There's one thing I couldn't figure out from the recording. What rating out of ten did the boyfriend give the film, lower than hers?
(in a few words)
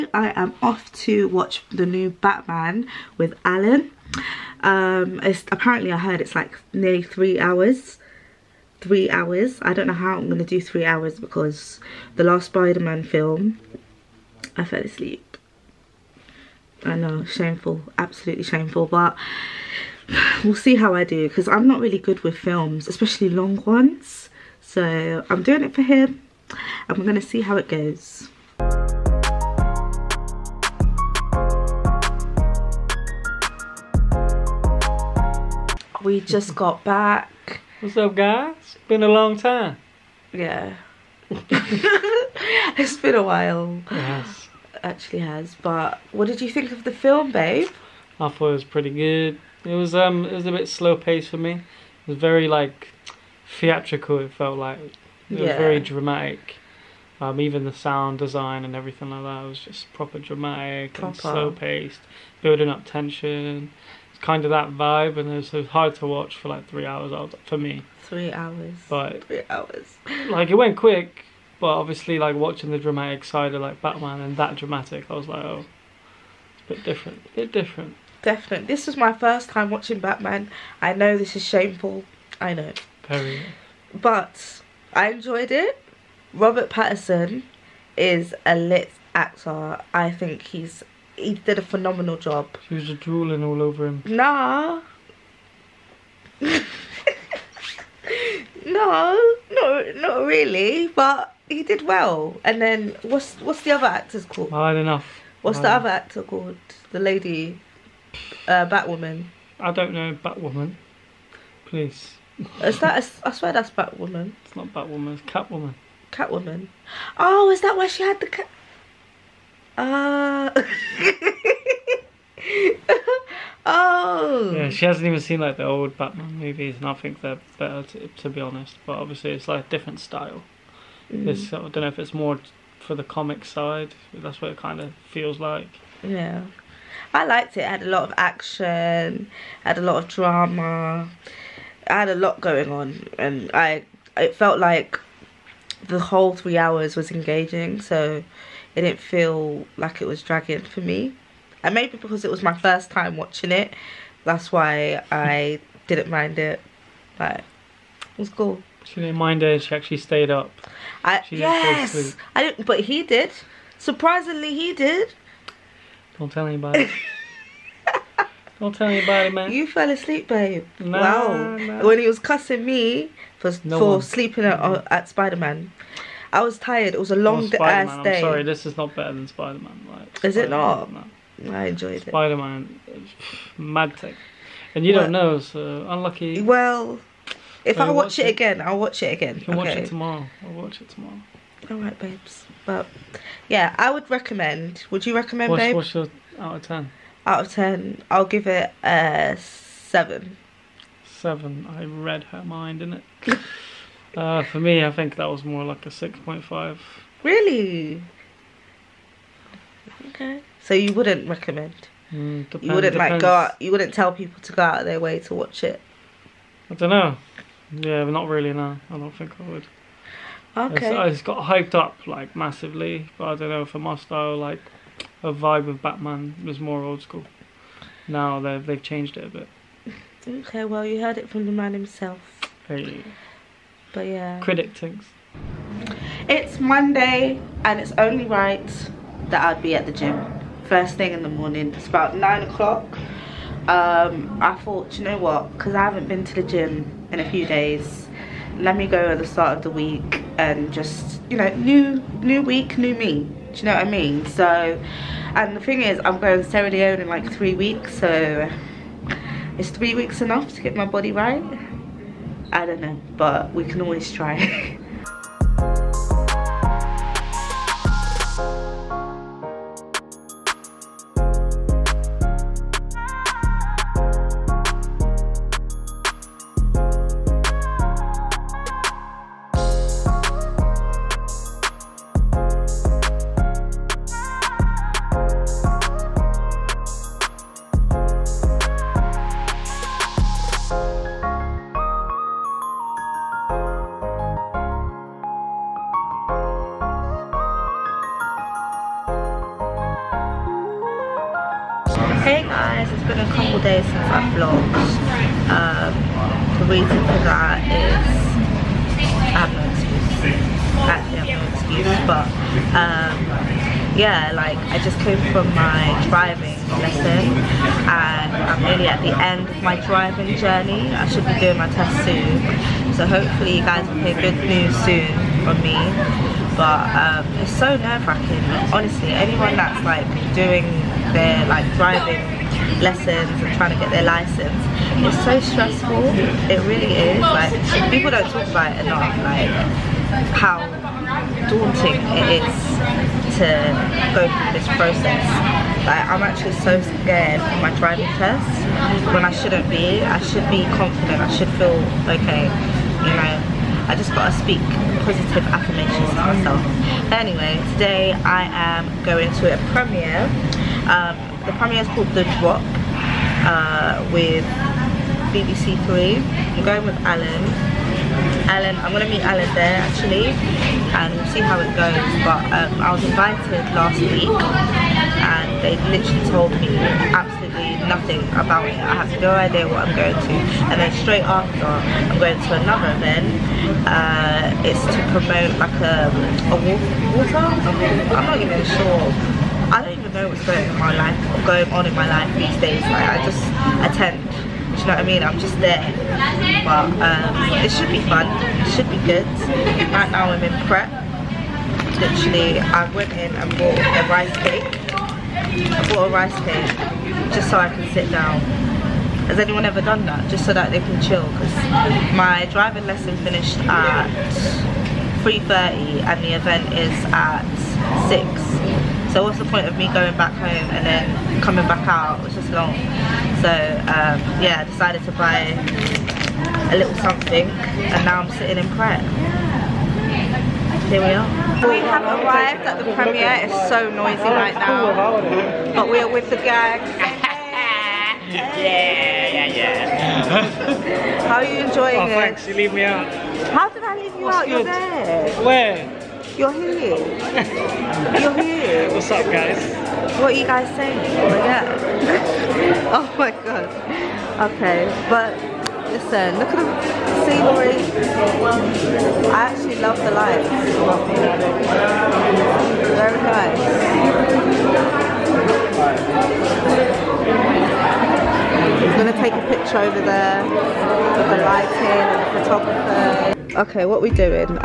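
6.5.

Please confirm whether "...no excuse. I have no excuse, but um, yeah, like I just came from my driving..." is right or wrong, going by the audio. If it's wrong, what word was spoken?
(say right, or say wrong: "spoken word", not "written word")
right.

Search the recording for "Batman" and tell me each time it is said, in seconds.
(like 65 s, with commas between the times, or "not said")
2 s, 73 s, 79 s, 125 s, 225 s.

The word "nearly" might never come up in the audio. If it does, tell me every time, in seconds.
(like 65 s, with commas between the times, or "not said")
6 s, 318 s.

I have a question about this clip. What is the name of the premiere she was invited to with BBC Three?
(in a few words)
The Drop.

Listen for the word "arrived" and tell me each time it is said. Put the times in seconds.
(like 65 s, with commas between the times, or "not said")
432 s.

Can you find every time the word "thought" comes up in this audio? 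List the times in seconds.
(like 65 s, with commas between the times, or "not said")
48 s, 244 s.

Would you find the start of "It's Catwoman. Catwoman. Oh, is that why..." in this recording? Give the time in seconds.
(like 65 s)
115 s.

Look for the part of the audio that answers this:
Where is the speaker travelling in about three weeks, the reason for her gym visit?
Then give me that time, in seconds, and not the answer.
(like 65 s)
256 s.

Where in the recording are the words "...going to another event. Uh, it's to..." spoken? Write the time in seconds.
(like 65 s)
382 s.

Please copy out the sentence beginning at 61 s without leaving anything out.
and slow paced, building up tension.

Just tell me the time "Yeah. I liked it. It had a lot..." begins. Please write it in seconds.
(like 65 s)
136 s.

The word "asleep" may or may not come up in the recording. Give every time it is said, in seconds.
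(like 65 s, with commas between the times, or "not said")
14 s, 169 s.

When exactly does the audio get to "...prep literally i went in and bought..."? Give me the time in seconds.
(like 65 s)
400 s.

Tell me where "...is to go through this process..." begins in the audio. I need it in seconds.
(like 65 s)
342 s.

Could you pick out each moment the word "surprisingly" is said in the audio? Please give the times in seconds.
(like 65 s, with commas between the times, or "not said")
163 s.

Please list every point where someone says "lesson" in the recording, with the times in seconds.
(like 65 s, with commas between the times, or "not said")
316 s, 332 s, 412 s.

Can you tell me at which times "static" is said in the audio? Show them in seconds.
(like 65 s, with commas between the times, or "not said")
not said.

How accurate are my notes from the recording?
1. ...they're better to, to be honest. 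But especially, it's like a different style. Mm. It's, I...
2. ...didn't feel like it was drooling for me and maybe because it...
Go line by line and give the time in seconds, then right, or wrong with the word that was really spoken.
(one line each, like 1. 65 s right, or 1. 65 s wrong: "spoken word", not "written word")
1. 127 s wrong: "obviously", not "especially"
2. 148 s wrong: "dragging", not "drooling".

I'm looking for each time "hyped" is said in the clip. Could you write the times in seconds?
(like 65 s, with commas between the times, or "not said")
221 s.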